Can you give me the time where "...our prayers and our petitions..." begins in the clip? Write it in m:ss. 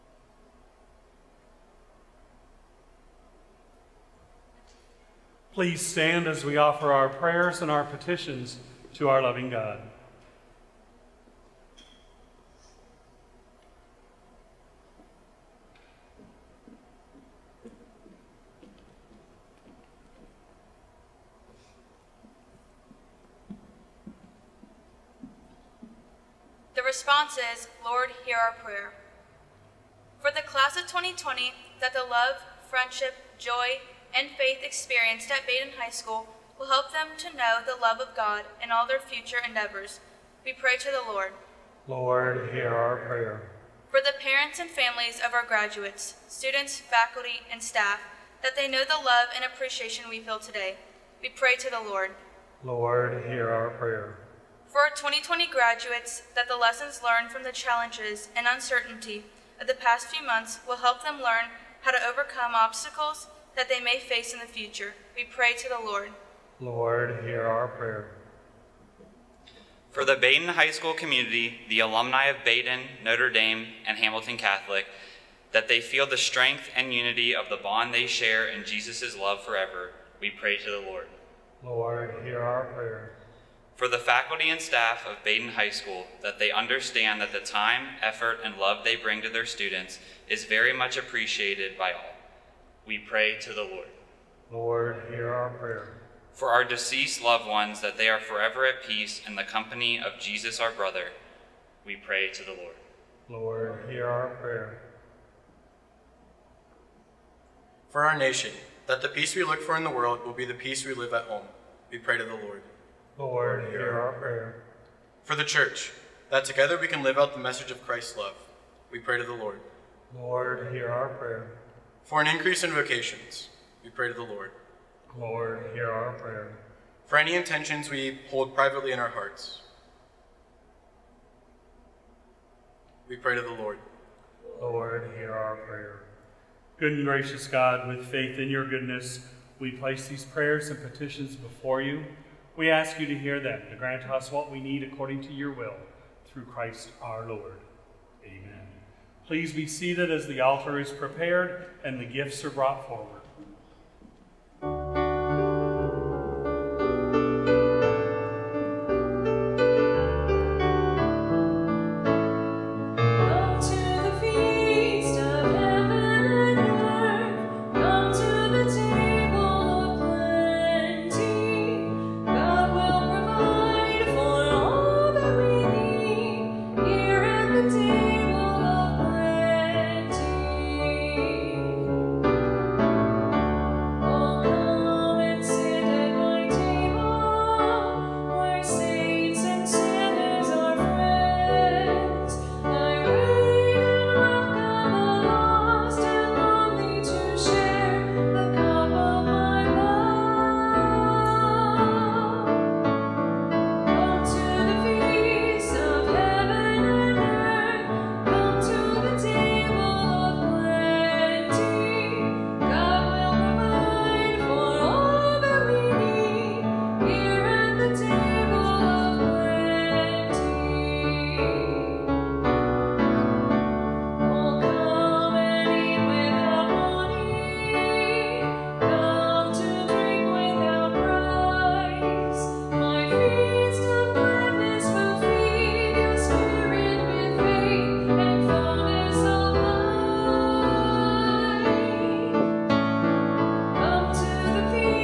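0:06.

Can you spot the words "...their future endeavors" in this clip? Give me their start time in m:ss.
0:38.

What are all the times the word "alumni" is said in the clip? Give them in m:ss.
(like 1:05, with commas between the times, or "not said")
1:11.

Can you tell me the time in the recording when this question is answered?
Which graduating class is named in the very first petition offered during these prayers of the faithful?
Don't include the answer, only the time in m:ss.
0:30.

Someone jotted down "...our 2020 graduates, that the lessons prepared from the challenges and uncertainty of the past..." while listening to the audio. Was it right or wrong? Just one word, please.
wrong.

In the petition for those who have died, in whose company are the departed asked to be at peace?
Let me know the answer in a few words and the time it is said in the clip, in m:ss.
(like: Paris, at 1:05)
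Jesus, at 1:40.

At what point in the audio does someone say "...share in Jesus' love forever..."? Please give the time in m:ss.
1:18.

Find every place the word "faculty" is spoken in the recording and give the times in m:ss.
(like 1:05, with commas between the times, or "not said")
0:46, 1:23.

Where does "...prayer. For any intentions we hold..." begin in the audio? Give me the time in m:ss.
2:06.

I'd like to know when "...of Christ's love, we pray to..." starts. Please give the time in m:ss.
1:57.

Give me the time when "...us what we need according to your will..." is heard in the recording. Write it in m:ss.
2:24.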